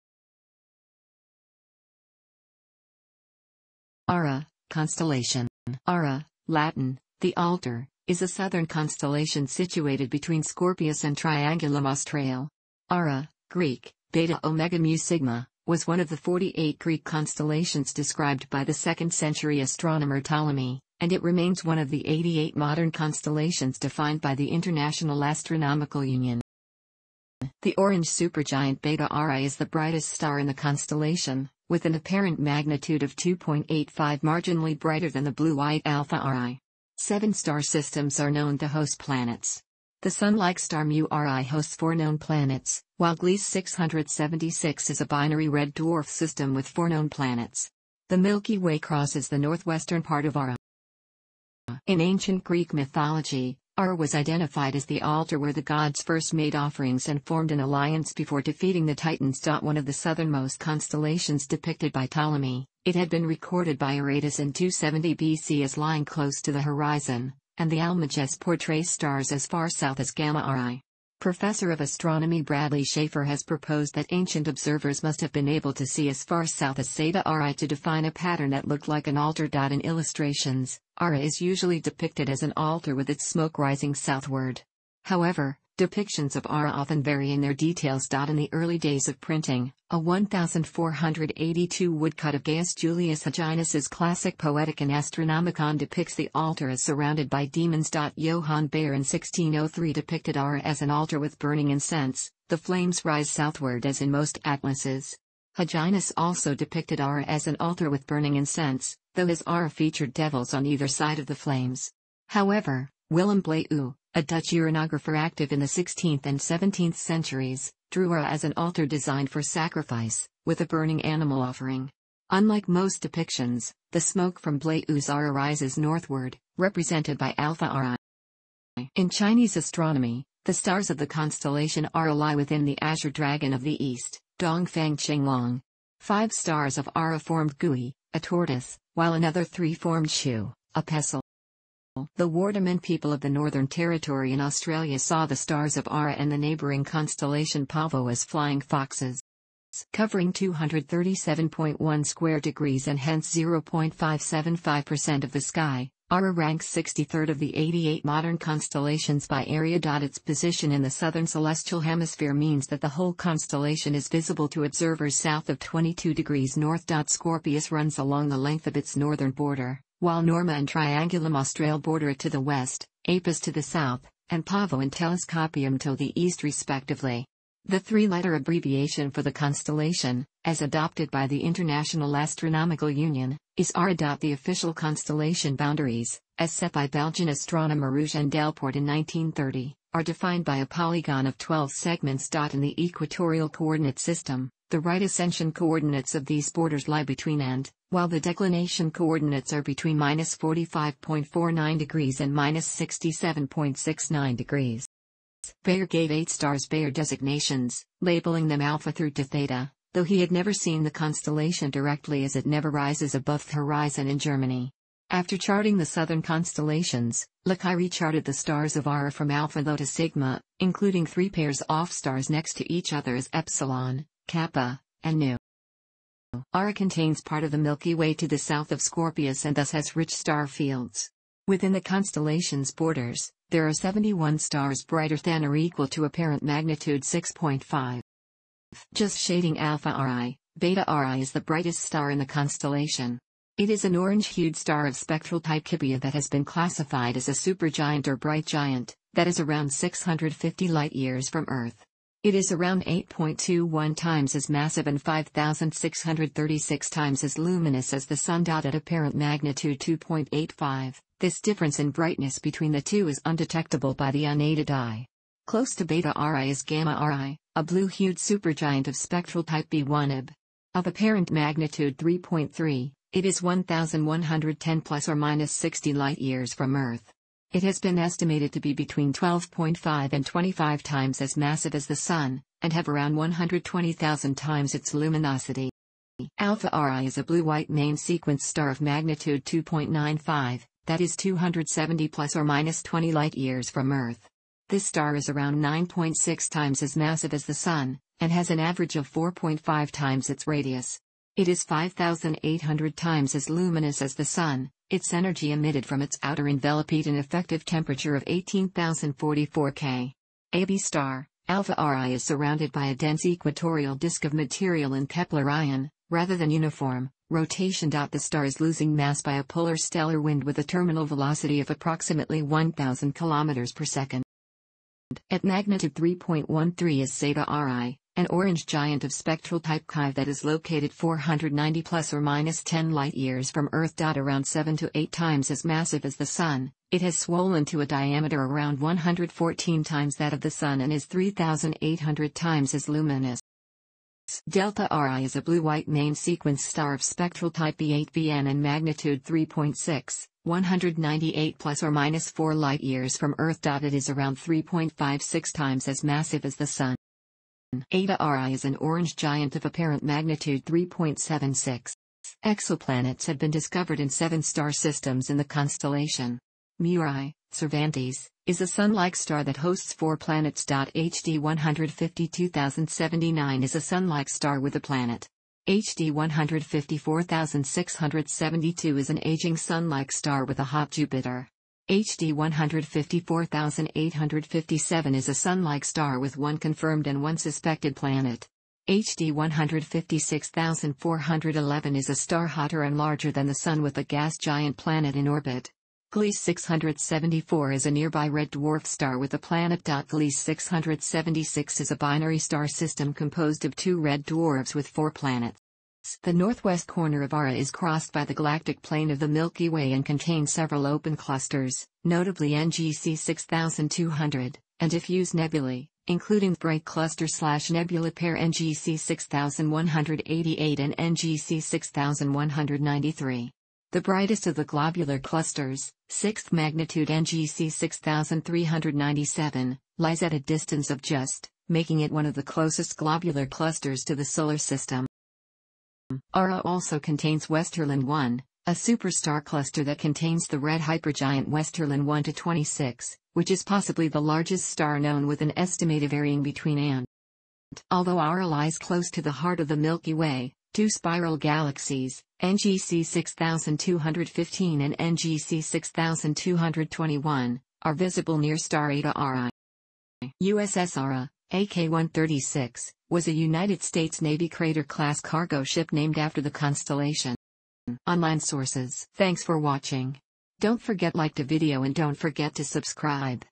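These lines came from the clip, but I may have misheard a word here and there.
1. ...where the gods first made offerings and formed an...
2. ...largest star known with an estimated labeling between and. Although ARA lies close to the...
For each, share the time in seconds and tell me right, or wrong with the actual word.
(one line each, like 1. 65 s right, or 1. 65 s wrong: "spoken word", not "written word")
1. 55 s right
2. 444 s wrong: "varying", not "labeling".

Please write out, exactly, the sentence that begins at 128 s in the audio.
In Chinese astronomy, the stars of the constellation Ara lie within the azure dragon of the east, Dongfang Qinglong.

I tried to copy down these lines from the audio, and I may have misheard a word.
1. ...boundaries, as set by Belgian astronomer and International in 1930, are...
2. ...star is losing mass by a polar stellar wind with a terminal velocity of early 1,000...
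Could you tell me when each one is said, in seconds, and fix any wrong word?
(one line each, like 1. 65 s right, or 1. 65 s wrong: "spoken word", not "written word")
1. 185 s wrong: "Delporte", not "International"
2. 318 s wrong: "approximately", not "early".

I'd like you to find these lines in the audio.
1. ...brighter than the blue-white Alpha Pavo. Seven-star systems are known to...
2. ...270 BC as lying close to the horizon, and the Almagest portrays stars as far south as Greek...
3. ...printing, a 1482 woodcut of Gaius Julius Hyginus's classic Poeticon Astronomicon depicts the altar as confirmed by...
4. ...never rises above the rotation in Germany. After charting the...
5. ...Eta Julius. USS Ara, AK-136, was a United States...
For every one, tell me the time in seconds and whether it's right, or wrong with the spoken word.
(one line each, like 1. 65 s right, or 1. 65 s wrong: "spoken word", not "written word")
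1. 34 s wrong: "Arae", not "Pavo"
2. 64 s wrong: "Gamma", not "Greek"
3. 89 s wrong: "surrounded", not "confirmed"
4. 212 s wrong: "horizon", not "rotation"
5. 458 s wrong: "Arae", not "Julius".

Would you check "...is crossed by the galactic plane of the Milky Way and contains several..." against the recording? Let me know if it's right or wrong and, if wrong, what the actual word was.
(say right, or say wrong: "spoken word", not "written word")
right.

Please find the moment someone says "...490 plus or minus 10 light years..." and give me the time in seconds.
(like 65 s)
330 s.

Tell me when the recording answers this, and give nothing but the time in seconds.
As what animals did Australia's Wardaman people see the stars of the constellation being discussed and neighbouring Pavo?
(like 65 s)
148 s.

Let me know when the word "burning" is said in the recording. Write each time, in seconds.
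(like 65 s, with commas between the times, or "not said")
101 s, 108 s, 120 s.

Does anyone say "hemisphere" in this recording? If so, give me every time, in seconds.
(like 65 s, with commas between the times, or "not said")
161 s.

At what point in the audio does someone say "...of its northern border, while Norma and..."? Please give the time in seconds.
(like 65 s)
168 s.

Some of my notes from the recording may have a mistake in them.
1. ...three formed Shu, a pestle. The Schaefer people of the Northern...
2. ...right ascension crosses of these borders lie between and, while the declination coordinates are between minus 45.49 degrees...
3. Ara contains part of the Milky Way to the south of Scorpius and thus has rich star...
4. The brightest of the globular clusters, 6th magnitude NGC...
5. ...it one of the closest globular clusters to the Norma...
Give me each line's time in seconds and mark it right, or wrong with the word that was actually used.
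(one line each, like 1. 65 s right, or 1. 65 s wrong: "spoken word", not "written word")
1. 139 s wrong: "Wardaman", not "Schaefer"
2. 194 s wrong: "coordinates", not "crosses"
3. 226 s right
4. 423 s right
5. 431 s wrong: "Solar", not "Norma".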